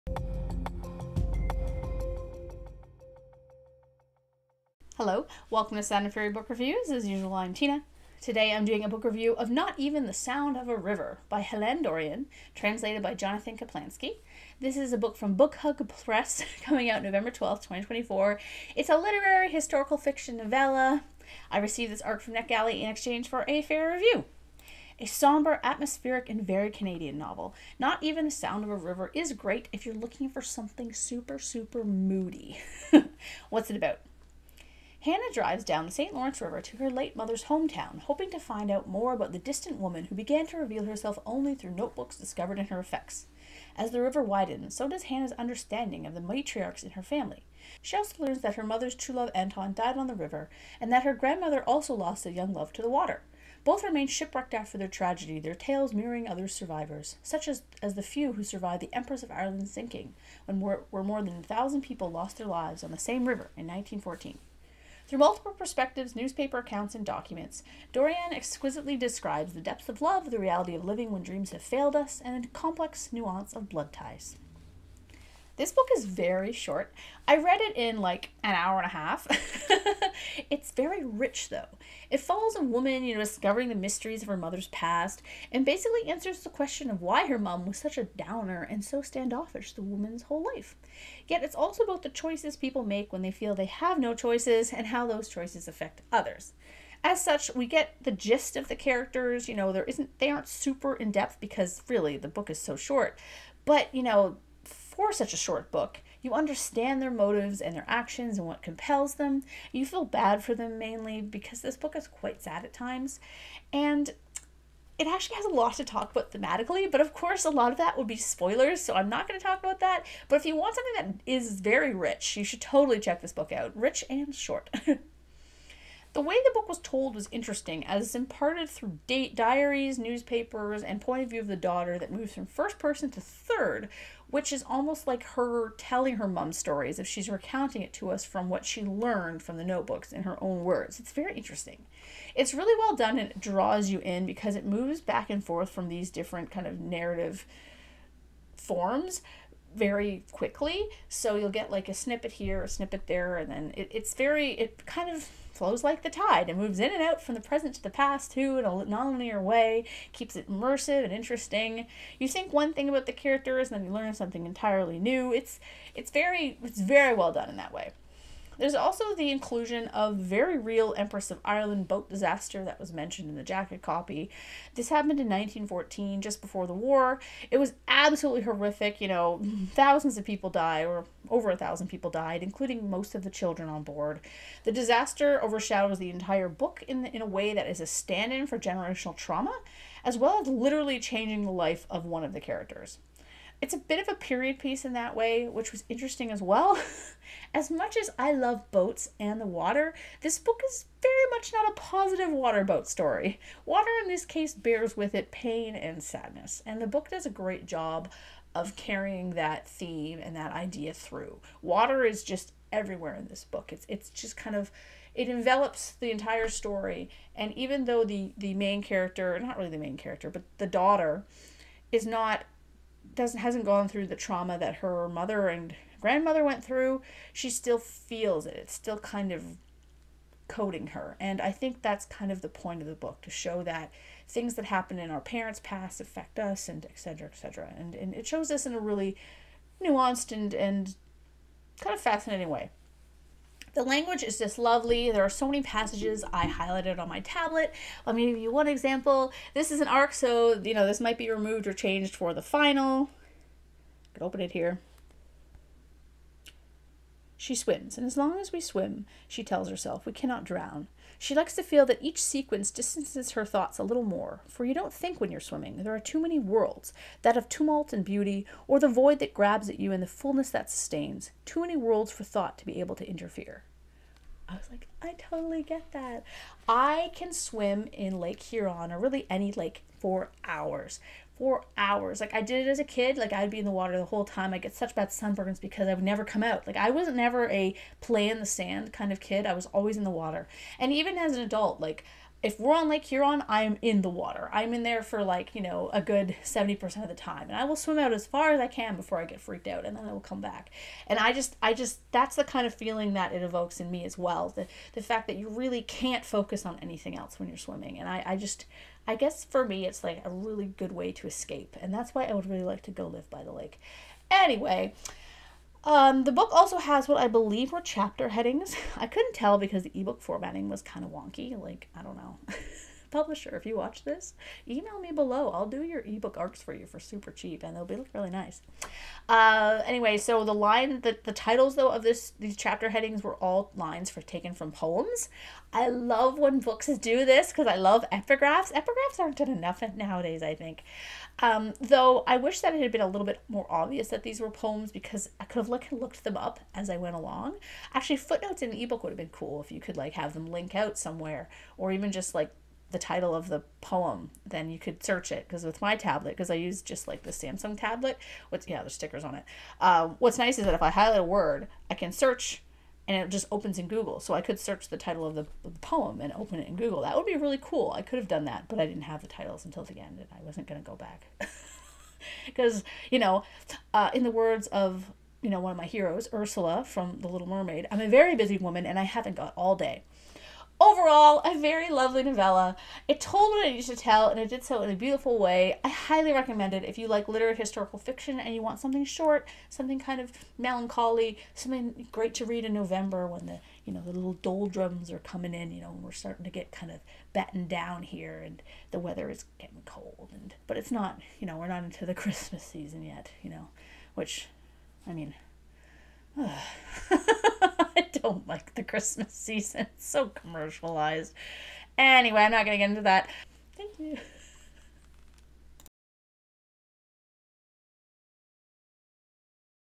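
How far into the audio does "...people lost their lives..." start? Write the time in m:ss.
1:01.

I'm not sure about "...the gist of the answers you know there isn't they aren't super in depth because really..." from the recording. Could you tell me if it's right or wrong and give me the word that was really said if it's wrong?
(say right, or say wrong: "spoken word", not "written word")
wrong: "characters", not "answers".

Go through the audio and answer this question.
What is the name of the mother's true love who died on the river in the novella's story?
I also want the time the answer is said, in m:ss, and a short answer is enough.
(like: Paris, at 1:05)
Anton, at 0:49.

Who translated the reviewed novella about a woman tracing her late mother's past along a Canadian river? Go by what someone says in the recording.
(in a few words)
Jonathan Kaplansky.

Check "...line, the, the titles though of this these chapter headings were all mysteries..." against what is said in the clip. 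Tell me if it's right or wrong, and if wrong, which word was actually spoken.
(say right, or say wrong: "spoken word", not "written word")
wrong: "lines", not "mysteries".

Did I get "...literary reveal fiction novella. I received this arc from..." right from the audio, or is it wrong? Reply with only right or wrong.
wrong.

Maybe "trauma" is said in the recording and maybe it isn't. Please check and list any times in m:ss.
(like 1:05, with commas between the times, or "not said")
3:09, 3:44.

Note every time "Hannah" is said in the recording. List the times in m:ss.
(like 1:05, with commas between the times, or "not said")
0:35, 0:45.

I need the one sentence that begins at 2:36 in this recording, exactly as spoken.
It moves in and out from the present to the past too in a nonlinear way, keeps it immersive and interesting.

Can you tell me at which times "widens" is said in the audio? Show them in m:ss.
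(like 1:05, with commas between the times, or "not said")
0:44.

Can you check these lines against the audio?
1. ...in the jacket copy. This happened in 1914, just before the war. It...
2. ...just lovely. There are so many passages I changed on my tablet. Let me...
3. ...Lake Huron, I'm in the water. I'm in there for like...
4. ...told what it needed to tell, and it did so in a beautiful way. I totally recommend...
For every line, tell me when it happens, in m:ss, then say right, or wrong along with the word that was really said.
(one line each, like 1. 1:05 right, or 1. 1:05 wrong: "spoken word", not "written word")
1. 2:53 right
2. 4:04 wrong: "highlighted", not "changed"
3. 4:52 right
4. 6:23 wrong: "highly", not "totally".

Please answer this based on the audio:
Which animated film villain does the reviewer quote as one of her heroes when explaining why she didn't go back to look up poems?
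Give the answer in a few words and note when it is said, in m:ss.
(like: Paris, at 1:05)
Ursula, at 6:16.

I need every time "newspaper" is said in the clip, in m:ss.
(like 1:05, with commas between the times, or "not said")
1:06, 2:09.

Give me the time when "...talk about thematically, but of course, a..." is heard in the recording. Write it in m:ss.
1:55.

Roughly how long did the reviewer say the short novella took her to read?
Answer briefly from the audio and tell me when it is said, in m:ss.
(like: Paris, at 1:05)
An hour and a half, at 1:18.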